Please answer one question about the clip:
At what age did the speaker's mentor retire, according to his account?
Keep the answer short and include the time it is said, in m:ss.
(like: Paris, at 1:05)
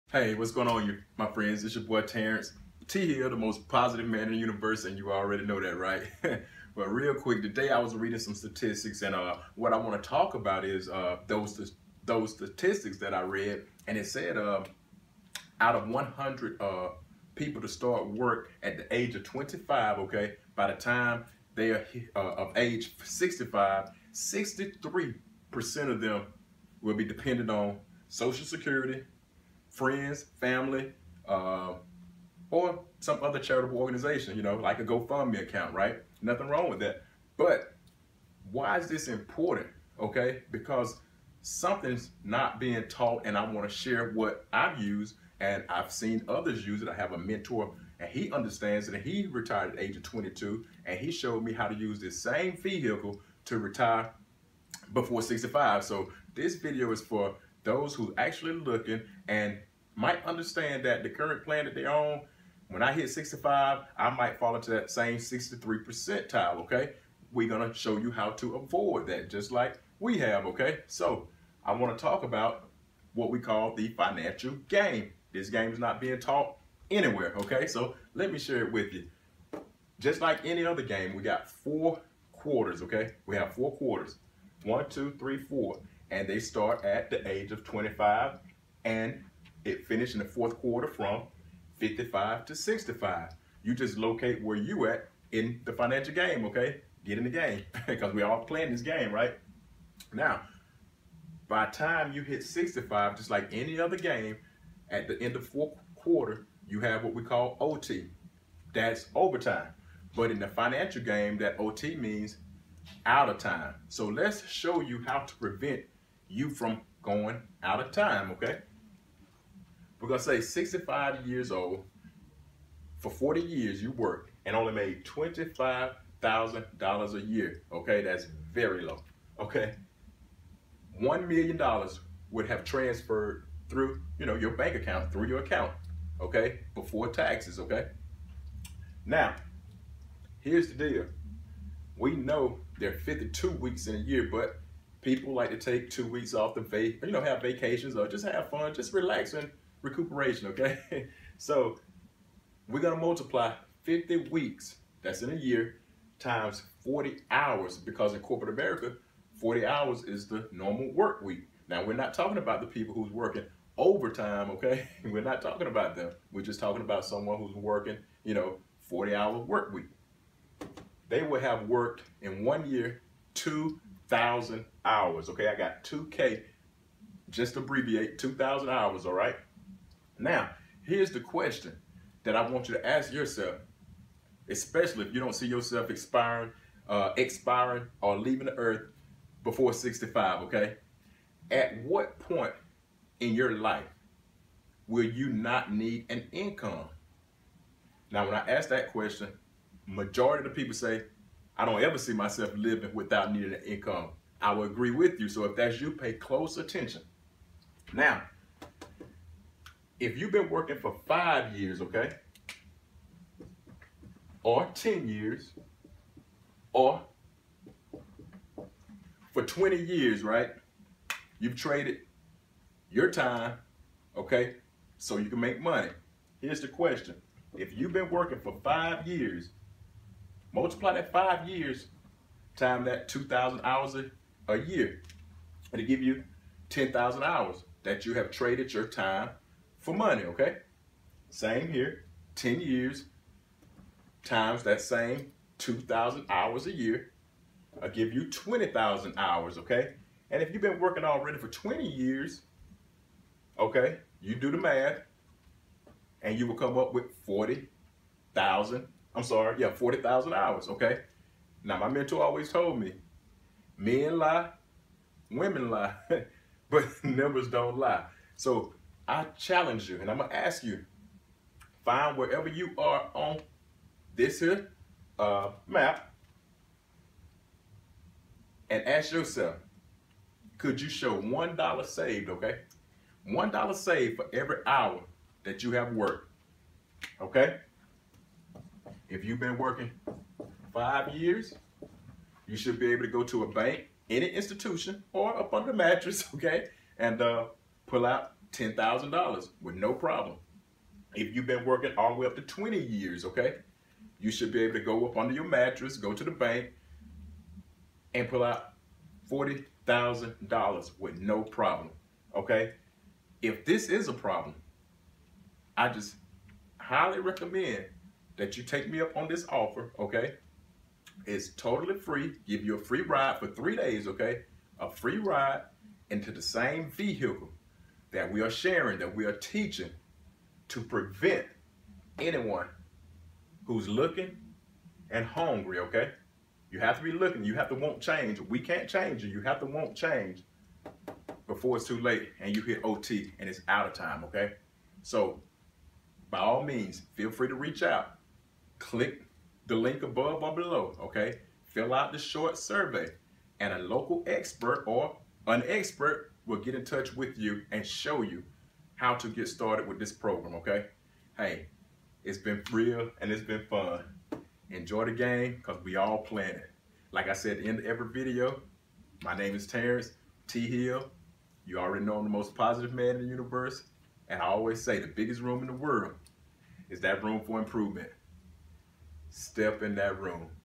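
22, at 0:50.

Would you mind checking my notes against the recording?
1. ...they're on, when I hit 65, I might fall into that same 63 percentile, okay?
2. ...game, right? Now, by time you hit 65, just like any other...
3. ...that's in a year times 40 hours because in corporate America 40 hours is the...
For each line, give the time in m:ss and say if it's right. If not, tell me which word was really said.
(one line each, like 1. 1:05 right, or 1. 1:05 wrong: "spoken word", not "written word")
1. 1:01 right
2. 1:38 right
3. 2:35 right.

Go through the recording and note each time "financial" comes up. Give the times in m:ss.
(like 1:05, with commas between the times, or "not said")
1:13, 1:35, 1:50.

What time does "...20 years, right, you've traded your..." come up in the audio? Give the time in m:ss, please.
3:39.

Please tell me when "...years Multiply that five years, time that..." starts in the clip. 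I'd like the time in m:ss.
3:49.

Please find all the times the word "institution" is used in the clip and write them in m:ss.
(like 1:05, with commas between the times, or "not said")
4:54.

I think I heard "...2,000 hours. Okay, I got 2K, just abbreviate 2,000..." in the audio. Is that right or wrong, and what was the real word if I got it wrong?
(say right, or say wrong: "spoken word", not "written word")
right.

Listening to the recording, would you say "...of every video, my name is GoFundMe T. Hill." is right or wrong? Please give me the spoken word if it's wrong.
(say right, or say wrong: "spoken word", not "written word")
wrong: "Tarence", not "GoFundMe".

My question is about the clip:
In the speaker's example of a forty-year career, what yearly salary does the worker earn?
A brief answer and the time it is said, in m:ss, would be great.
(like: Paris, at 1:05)
$25,000, at 2:05.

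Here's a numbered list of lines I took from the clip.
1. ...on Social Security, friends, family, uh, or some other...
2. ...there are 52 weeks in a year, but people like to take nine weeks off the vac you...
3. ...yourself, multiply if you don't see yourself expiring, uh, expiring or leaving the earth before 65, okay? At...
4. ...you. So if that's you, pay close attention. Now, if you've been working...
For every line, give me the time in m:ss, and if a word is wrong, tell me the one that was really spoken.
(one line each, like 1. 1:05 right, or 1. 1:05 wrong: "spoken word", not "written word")
1. 0:27 right
2. 2:22 wrong: "two", not "nine"
3. 3:03 wrong: "especially", not "multiply"
4. 3:25 right.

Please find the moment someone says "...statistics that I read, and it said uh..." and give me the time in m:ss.
0:12.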